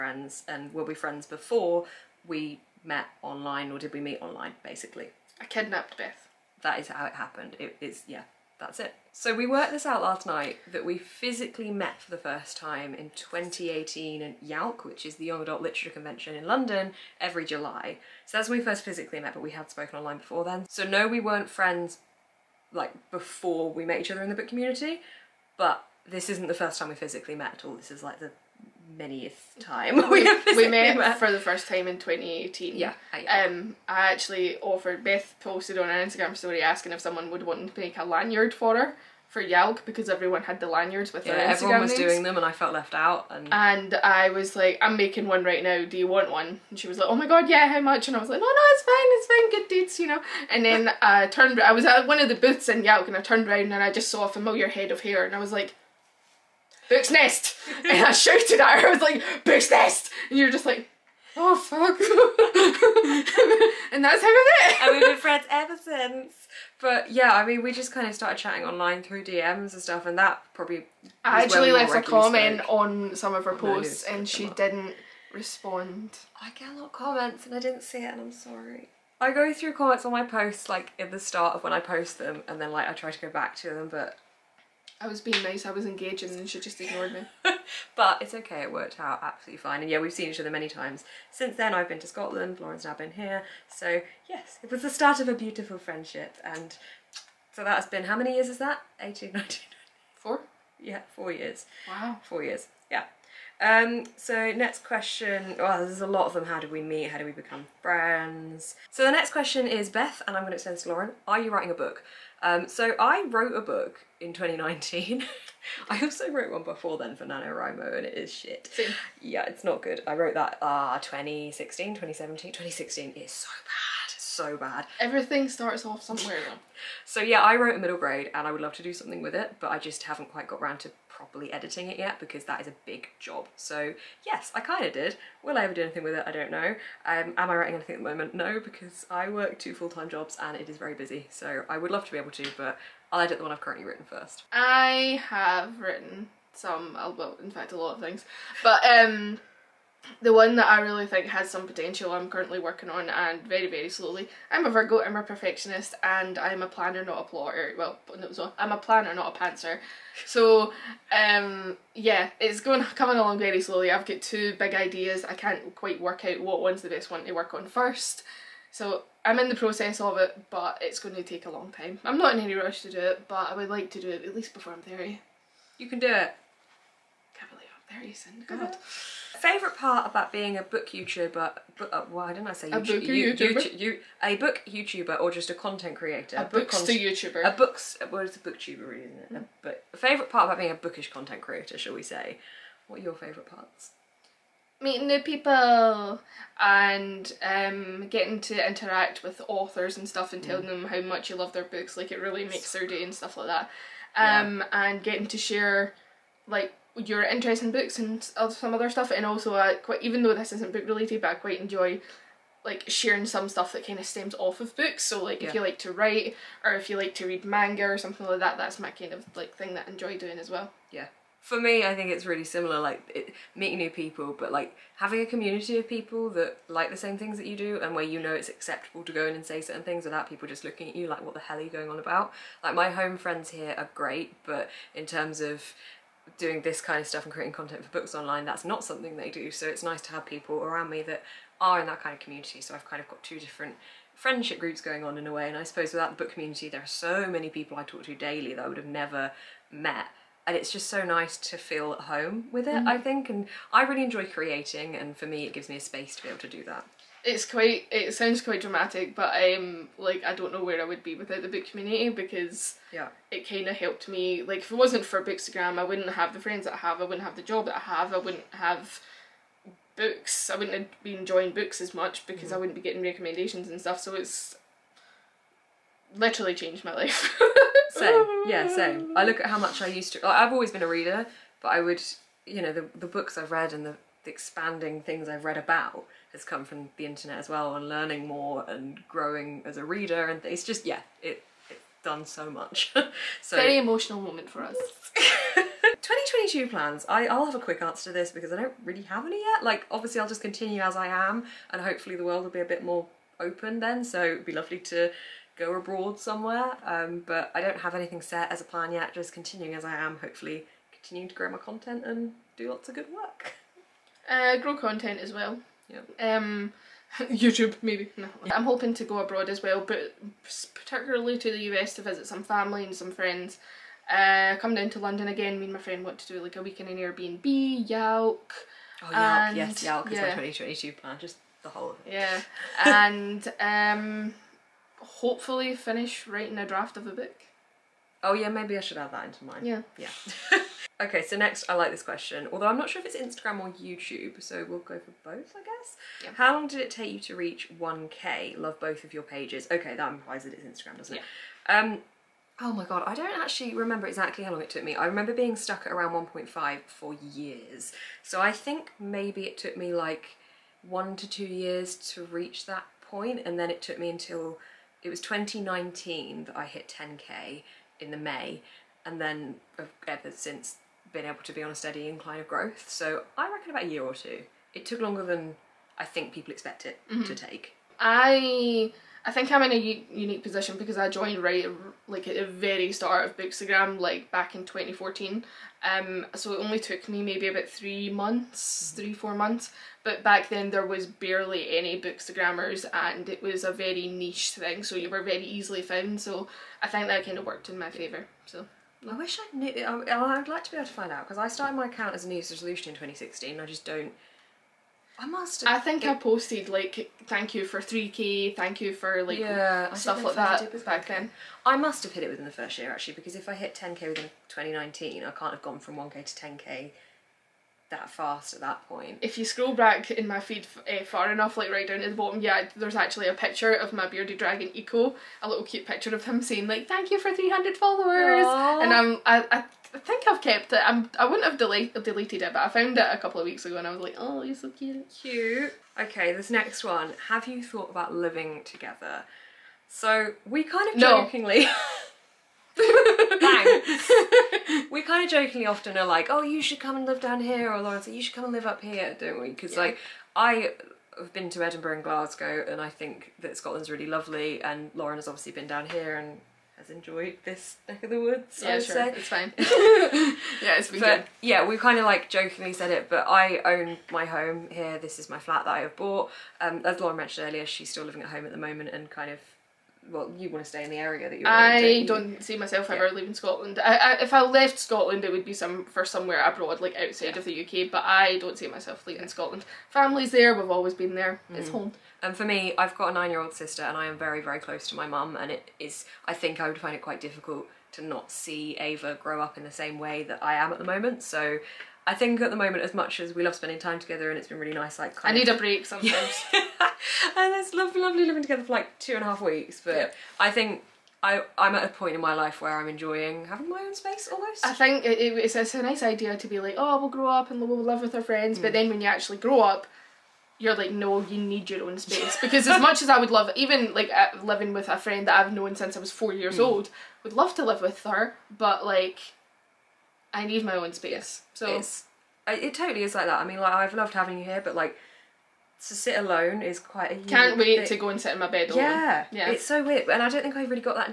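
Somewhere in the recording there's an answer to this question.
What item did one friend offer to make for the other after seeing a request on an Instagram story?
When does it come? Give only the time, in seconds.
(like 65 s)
37 s.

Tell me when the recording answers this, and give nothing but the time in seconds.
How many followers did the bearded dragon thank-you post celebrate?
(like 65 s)
427 s.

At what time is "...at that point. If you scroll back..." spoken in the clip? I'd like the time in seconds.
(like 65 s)
418 s.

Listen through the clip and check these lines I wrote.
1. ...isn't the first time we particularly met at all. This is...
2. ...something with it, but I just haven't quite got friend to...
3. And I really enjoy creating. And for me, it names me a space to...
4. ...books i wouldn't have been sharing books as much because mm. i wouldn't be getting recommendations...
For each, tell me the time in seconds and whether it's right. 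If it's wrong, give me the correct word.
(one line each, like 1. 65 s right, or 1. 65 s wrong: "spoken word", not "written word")
1. 26 s wrong: "physically", not "particularly"
2. 128 s wrong: "round", not "friend"
3. 253 s wrong: "gives", not "names"
4. 269 s wrong: "enjoying", not "sharing".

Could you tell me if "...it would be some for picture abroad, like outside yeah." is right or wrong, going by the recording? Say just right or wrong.
wrong.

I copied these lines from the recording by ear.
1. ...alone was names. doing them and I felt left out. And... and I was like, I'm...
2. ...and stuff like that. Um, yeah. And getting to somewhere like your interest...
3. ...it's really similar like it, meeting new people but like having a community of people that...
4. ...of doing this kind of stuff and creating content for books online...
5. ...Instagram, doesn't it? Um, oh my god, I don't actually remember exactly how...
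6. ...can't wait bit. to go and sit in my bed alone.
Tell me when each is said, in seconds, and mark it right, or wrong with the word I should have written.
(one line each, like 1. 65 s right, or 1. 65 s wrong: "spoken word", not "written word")
1. 41 s wrong: "everyone", not "alone"
2. 203 s wrong: "share", not "somewhere"
3. 222 s right
4. 235 s right
5. 350 s right
6. 527 s right.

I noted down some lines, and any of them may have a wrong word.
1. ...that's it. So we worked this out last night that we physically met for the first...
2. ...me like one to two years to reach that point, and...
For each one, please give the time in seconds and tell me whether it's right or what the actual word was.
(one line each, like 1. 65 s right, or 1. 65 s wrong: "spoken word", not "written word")
1. 8 s right
2. 359 s right.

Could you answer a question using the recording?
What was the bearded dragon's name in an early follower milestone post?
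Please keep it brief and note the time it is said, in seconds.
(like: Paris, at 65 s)
Eco, at 424 s.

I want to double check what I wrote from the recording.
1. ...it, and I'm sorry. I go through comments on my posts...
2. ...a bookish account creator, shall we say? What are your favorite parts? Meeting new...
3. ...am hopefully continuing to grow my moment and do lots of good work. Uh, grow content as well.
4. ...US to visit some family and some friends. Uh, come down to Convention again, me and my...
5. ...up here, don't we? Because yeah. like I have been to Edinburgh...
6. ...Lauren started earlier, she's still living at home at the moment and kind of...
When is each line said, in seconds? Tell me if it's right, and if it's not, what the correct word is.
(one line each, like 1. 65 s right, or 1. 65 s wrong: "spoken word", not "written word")
1. 78 s right
2. 190 s wrong: "content", not "account"
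3. 309 s wrong: "content", not "moment"
4. 321 s wrong: "London", not "Convention"
5. 448 s right
6. 466 s wrong: "mentioned", not "started".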